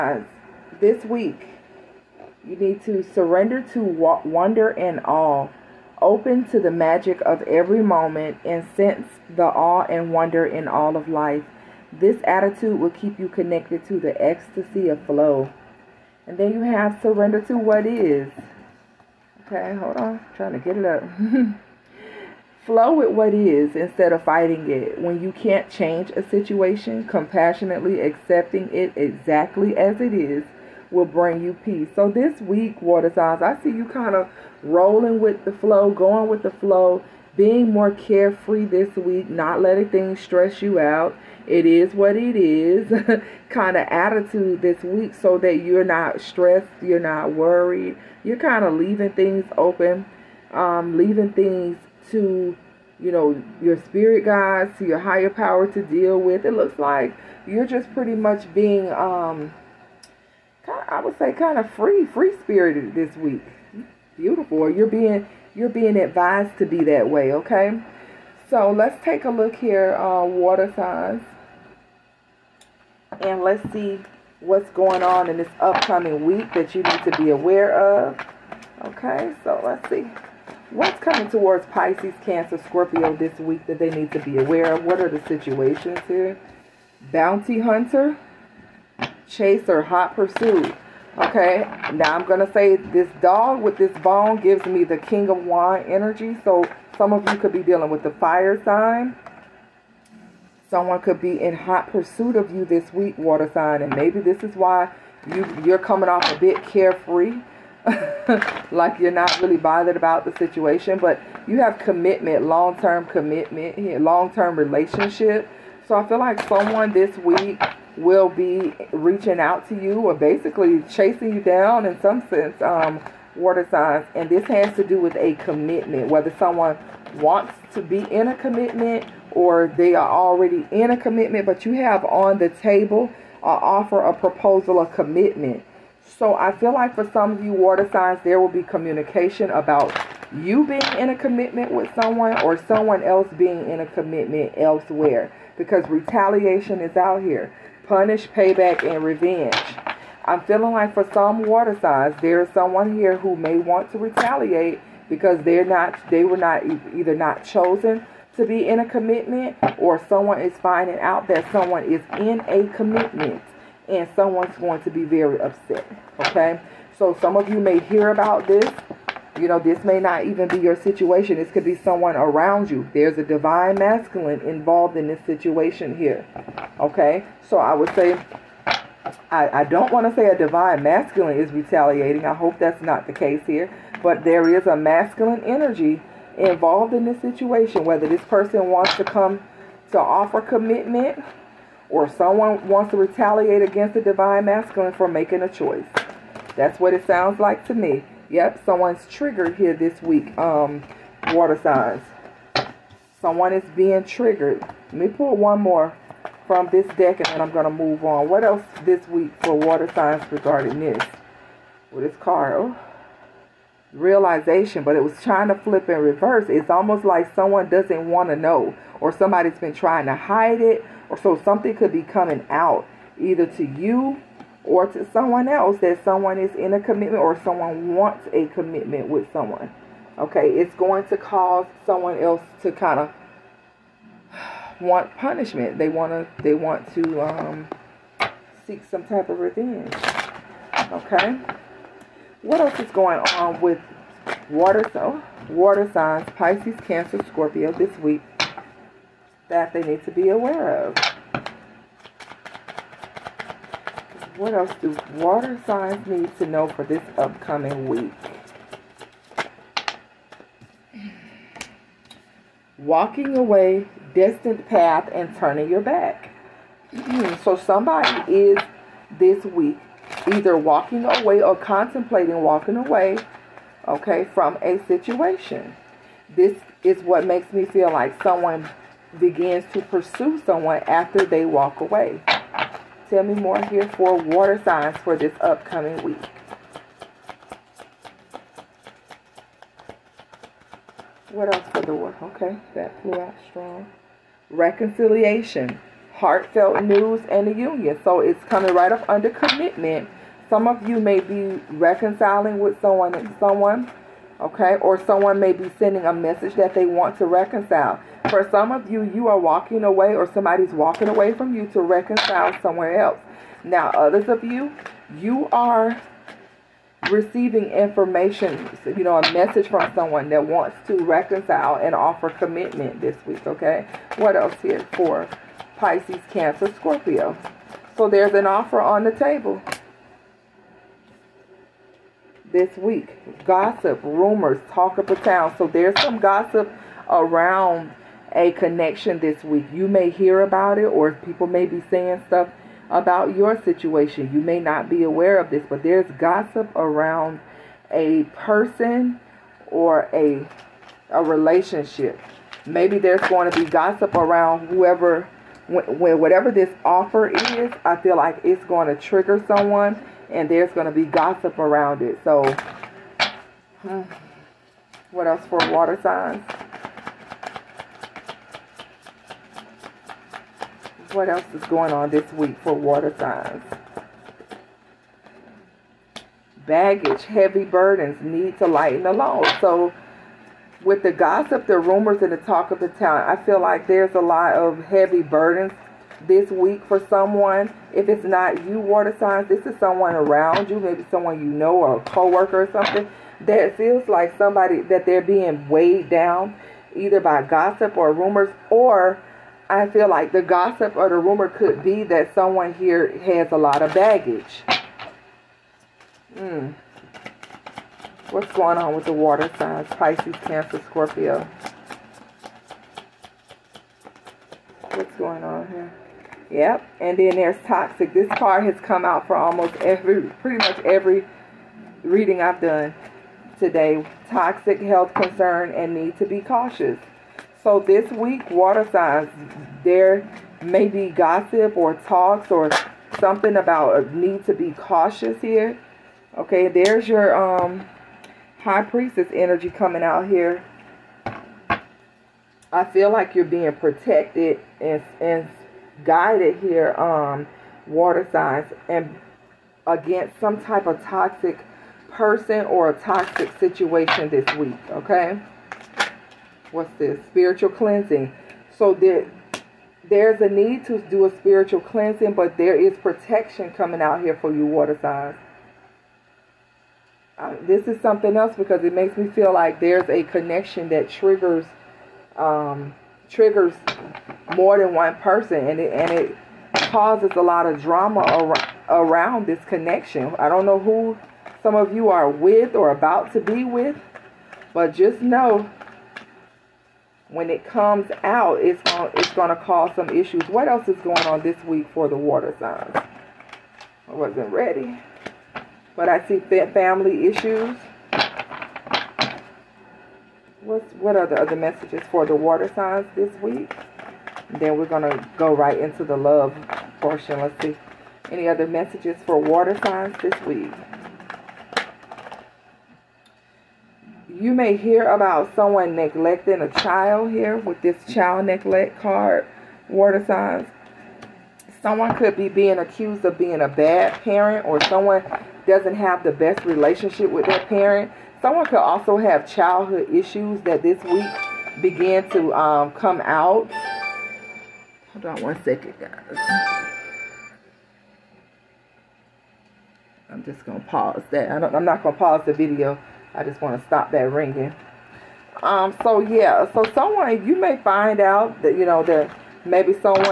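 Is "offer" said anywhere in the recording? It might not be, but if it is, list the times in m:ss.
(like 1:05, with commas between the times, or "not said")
2:13, 3:09, 5:21, 5:28, 5:56.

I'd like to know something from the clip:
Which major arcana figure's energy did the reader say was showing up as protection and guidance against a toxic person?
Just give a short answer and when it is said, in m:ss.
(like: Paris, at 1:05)
High Priestess, at 7:18.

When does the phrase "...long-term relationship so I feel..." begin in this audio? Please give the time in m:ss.
1:54.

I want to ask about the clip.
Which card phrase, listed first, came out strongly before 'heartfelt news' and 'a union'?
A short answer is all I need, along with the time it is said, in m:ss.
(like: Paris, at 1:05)
Reconciliation, at 4:54.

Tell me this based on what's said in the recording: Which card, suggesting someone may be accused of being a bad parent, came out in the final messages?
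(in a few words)
child neglect.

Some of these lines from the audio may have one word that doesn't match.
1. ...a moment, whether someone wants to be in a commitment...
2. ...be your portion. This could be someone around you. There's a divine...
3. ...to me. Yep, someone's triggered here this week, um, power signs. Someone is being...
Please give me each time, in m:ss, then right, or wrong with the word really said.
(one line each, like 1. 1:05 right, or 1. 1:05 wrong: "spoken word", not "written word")
1. 2:05 wrong: "commitment", not "moment"
2. 2:50 wrong: "situation", not "portion"
3. 3:17 wrong: "water", not "power".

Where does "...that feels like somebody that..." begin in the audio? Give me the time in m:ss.
6:33.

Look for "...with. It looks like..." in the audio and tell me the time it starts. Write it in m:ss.
0:56.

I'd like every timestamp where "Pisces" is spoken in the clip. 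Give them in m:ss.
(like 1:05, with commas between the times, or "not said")
1:21, 4:06, 5:25, 6:49.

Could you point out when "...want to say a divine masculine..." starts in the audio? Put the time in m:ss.
2:59.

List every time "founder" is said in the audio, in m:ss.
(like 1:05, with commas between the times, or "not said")
not said.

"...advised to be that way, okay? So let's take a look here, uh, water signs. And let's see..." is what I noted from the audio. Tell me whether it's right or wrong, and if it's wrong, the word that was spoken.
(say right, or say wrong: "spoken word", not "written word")
right.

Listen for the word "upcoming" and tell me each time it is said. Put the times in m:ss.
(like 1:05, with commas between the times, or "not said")
1:15, 4:17, 4:45.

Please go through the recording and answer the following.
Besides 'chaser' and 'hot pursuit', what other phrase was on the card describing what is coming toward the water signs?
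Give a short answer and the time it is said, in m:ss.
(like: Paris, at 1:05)
Bounty hunter, at 1:27.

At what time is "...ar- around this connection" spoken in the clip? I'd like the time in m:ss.
7:58.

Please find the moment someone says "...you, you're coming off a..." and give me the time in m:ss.
1:45.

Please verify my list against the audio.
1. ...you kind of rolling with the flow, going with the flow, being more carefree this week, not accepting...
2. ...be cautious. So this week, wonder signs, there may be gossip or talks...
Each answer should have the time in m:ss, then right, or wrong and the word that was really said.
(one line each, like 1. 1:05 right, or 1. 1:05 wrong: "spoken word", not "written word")
1. 0:33 wrong: "letting", not "accepting"
2. 7:06 wrong: "water", not "wonder".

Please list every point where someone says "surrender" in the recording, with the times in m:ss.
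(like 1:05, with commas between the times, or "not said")
0:03, 0:17.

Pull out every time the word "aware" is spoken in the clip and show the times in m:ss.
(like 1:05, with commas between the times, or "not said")
1:17, 1:24, 4:10, 5:45.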